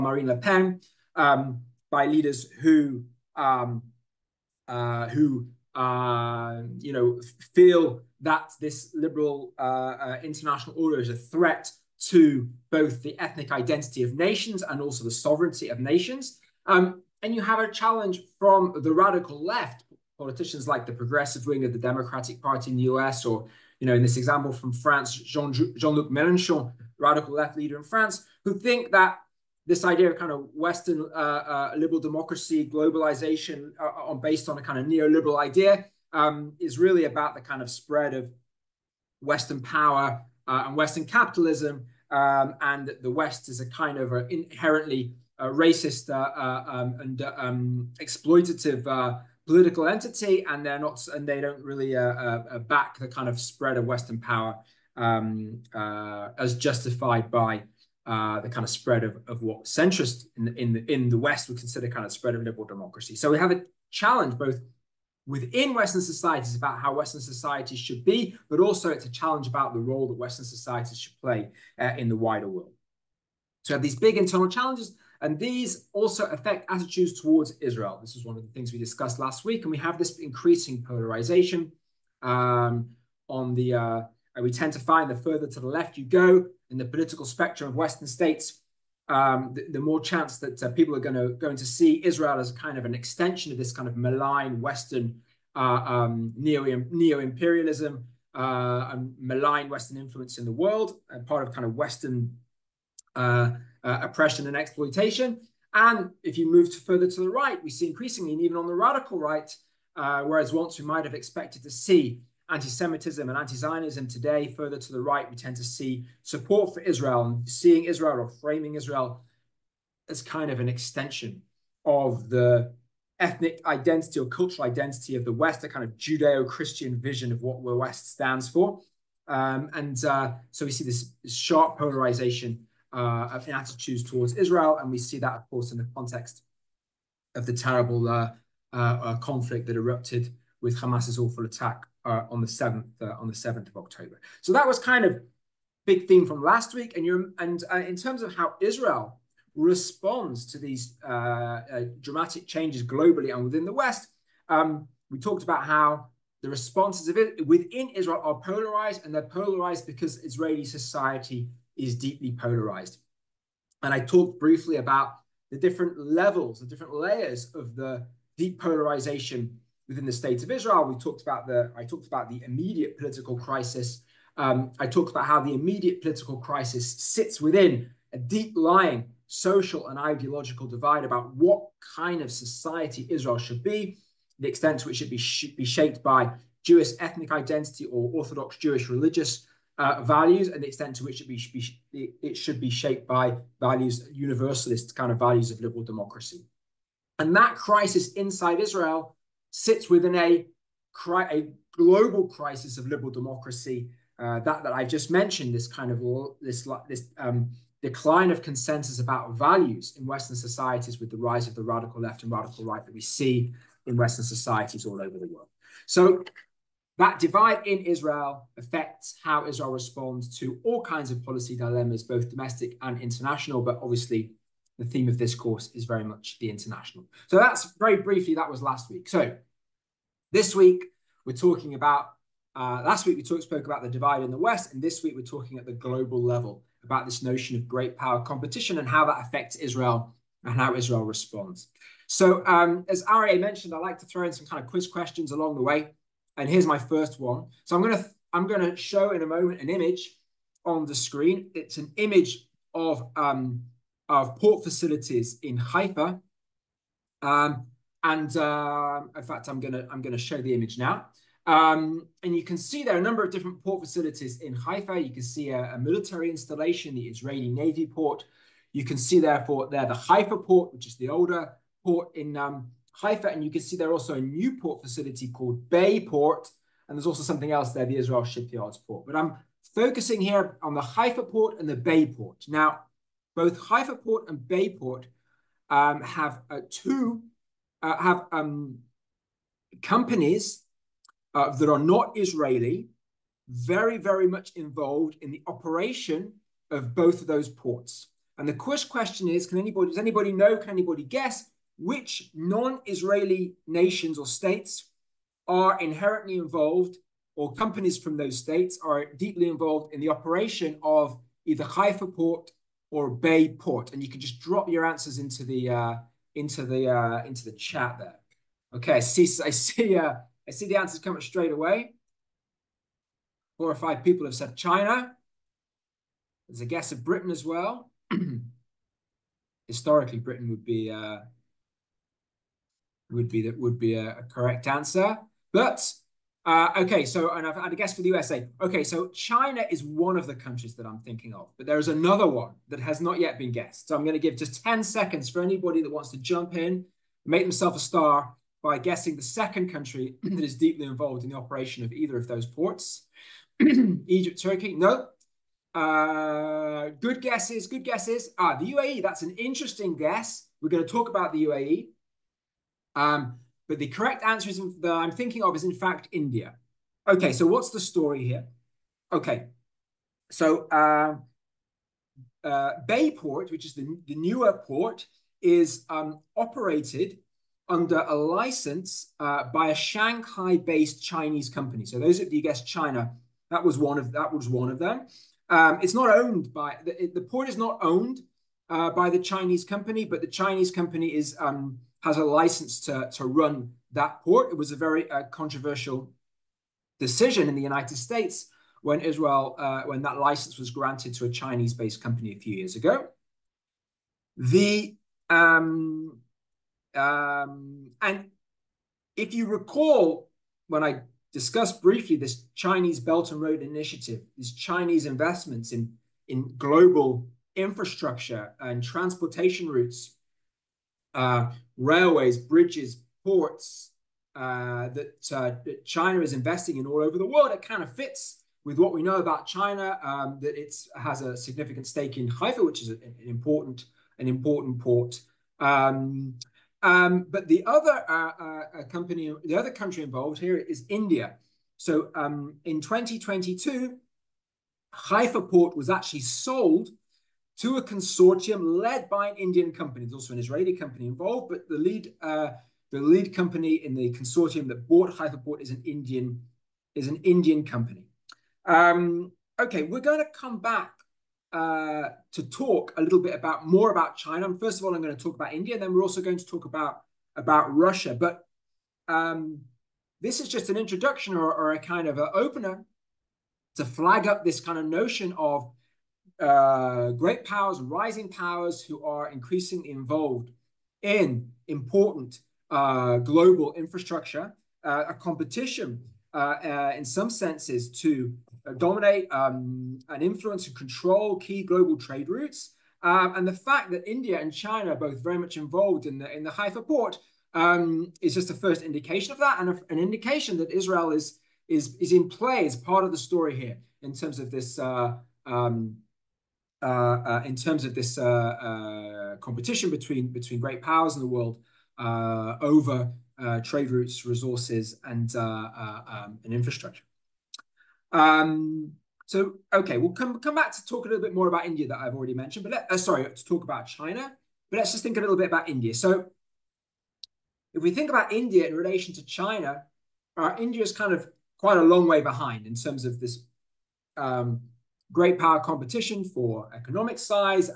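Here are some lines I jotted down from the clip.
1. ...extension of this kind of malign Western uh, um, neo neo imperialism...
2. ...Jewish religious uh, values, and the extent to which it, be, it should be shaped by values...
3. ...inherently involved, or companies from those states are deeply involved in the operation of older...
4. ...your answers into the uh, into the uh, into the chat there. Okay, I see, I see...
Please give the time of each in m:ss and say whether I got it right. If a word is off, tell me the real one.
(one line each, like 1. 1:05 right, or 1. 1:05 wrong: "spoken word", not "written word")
1. 1:32 right
2. 3:08 right
3. 5:05 wrong: "either", not "older"
4. 5:14 right.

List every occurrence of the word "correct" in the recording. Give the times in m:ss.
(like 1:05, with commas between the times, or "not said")
5:34, 6:03.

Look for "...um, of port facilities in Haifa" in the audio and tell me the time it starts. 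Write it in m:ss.
4:13.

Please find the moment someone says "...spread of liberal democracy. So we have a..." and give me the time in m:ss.
1:02.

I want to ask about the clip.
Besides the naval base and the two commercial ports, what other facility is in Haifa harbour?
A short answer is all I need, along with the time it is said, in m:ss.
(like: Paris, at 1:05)
Israel Shipyards port, at 4:37.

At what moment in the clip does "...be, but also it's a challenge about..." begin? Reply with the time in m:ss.
1:08.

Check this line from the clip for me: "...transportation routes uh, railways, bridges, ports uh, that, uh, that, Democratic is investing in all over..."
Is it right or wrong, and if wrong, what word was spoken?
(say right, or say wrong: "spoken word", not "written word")
wrong: "China", not "Democratic".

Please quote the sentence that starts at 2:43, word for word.
And I talked briefly about the different levels, the different layers of the deep polarization within the state of Israel.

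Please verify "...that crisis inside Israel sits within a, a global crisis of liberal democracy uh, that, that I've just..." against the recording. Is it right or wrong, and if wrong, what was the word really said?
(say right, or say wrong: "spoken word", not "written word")
right.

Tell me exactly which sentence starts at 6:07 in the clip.
Okay, so what's the story here?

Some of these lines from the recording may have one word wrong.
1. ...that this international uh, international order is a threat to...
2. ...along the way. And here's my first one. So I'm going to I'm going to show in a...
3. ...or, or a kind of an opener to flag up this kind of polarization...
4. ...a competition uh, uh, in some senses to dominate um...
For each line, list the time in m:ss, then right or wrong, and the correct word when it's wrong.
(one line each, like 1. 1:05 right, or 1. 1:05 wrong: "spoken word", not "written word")
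1. 0:08 wrong: "liberal", not "international"
2. 4:05 right
3. 7:51 wrong: "notion", not "polarization"
4. 8:05 right.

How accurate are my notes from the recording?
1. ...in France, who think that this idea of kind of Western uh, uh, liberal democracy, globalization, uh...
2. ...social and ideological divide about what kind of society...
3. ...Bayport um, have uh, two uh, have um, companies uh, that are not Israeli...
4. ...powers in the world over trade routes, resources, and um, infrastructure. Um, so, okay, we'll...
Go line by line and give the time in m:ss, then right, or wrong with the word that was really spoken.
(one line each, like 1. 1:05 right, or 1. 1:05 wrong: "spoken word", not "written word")
1. 0:27 right
2. 2:59 right
3. 4:44 right
4. 8:30 right.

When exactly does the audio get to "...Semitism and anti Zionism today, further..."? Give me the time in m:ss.
1:52.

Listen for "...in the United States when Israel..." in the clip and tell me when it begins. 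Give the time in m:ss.
6:37.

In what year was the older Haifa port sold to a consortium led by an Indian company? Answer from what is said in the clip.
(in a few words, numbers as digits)
2022.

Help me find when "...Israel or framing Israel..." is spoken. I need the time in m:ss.
1:57.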